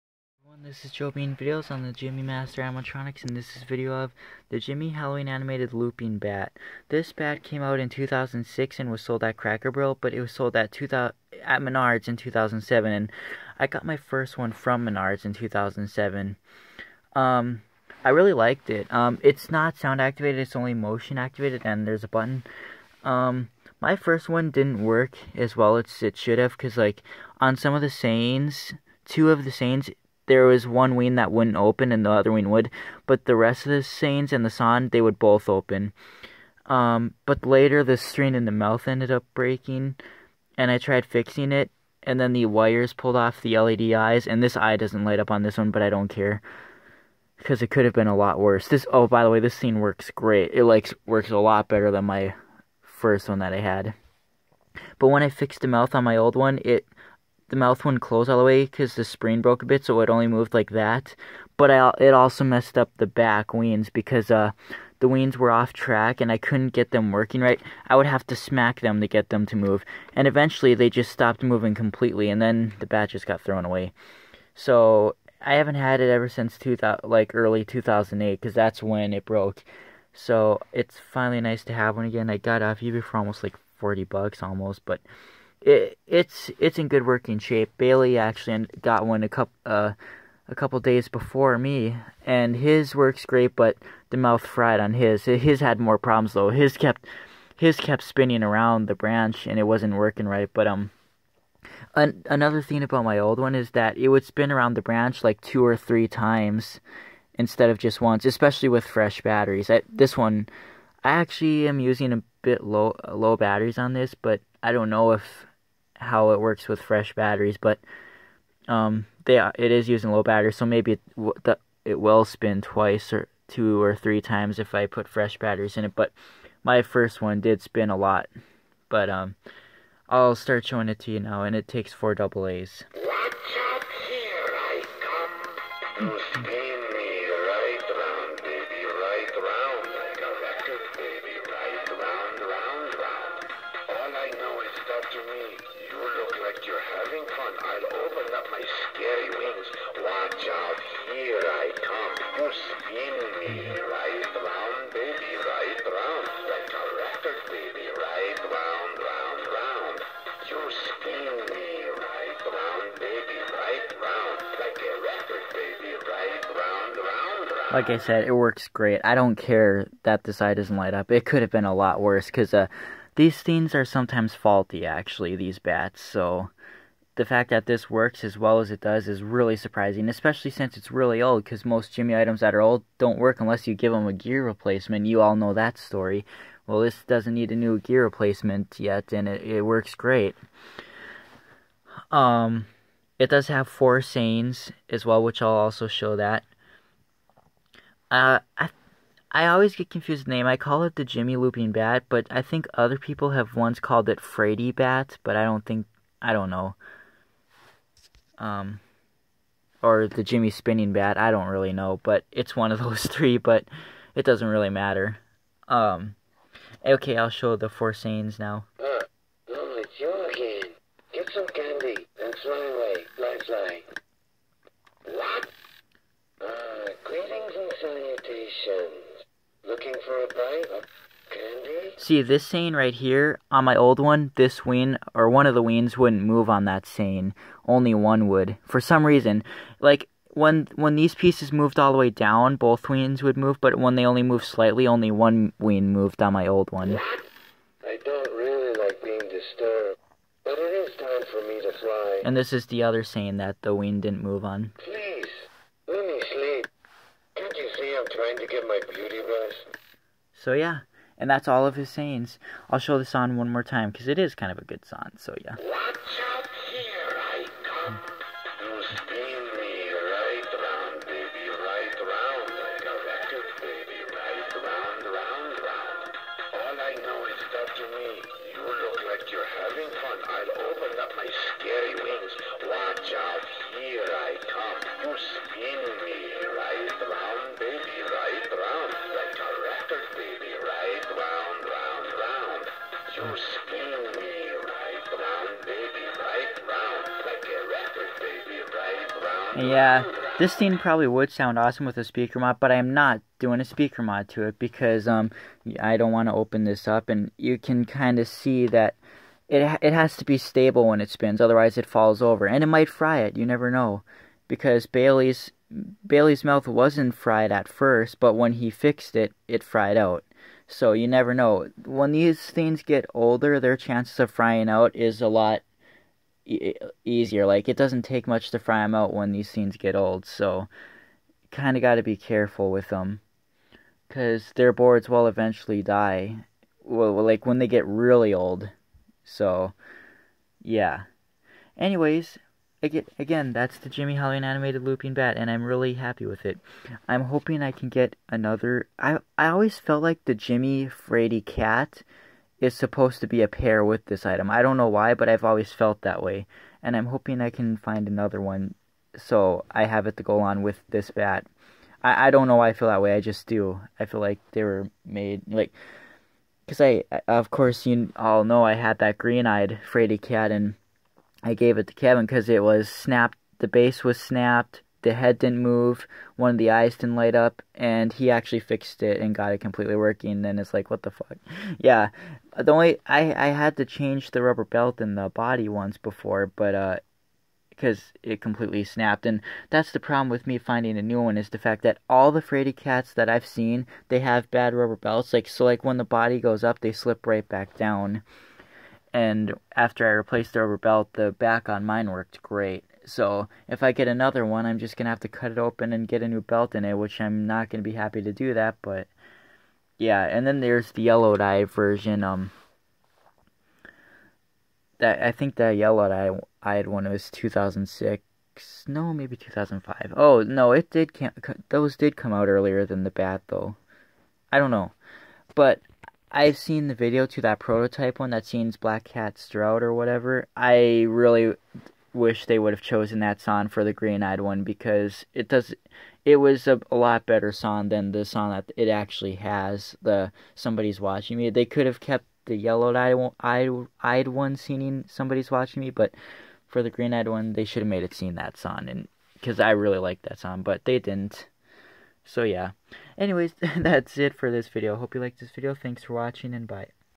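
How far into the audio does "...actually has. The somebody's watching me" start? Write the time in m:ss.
7:18.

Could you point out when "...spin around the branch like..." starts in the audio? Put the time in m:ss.
1:44.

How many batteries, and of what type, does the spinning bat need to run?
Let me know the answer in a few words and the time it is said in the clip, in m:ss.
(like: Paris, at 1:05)
4 AA, at 2:11.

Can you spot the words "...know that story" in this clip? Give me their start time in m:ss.
3:05.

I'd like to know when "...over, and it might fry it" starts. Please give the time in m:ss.
5:12.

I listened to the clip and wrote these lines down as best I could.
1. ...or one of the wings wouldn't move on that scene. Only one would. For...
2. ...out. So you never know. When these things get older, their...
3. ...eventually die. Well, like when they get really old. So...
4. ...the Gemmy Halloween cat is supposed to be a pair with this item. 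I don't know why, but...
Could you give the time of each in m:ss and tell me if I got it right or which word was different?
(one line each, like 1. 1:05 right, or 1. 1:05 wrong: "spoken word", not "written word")
1. 3:55 right
2. 5:19 right
3. 5:35 right
4. 5:50 wrong: "Fraidy", not "Halloween".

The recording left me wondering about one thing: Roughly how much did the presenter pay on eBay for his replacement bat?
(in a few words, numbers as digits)
40 bucks.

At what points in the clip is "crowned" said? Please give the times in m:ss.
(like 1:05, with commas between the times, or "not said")
not said.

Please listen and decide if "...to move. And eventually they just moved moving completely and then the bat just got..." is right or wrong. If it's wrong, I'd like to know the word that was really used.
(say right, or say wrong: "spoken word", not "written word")
wrong: "stopped", not "moved".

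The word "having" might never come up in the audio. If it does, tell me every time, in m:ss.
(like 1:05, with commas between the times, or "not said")
2:26.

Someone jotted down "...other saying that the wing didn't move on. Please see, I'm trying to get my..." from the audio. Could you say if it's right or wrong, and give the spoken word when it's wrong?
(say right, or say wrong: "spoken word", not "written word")
right.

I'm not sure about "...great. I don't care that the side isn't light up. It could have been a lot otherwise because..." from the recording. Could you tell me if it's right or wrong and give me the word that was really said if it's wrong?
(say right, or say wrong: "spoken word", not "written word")
wrong: "worse", not "otherwise".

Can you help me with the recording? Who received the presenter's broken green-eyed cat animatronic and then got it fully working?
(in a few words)
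Kevin.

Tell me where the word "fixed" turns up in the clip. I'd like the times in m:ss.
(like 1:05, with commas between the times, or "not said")
0:55, 5:18, 6:18.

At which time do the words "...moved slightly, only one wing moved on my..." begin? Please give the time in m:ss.
4:04.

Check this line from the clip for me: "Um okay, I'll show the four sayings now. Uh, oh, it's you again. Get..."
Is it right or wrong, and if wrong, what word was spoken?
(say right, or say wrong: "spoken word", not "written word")
right.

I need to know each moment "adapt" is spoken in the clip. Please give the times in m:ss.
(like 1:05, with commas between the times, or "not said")
not said.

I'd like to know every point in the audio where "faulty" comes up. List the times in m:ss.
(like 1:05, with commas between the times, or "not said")
2:54.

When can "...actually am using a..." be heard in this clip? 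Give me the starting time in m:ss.
1:51.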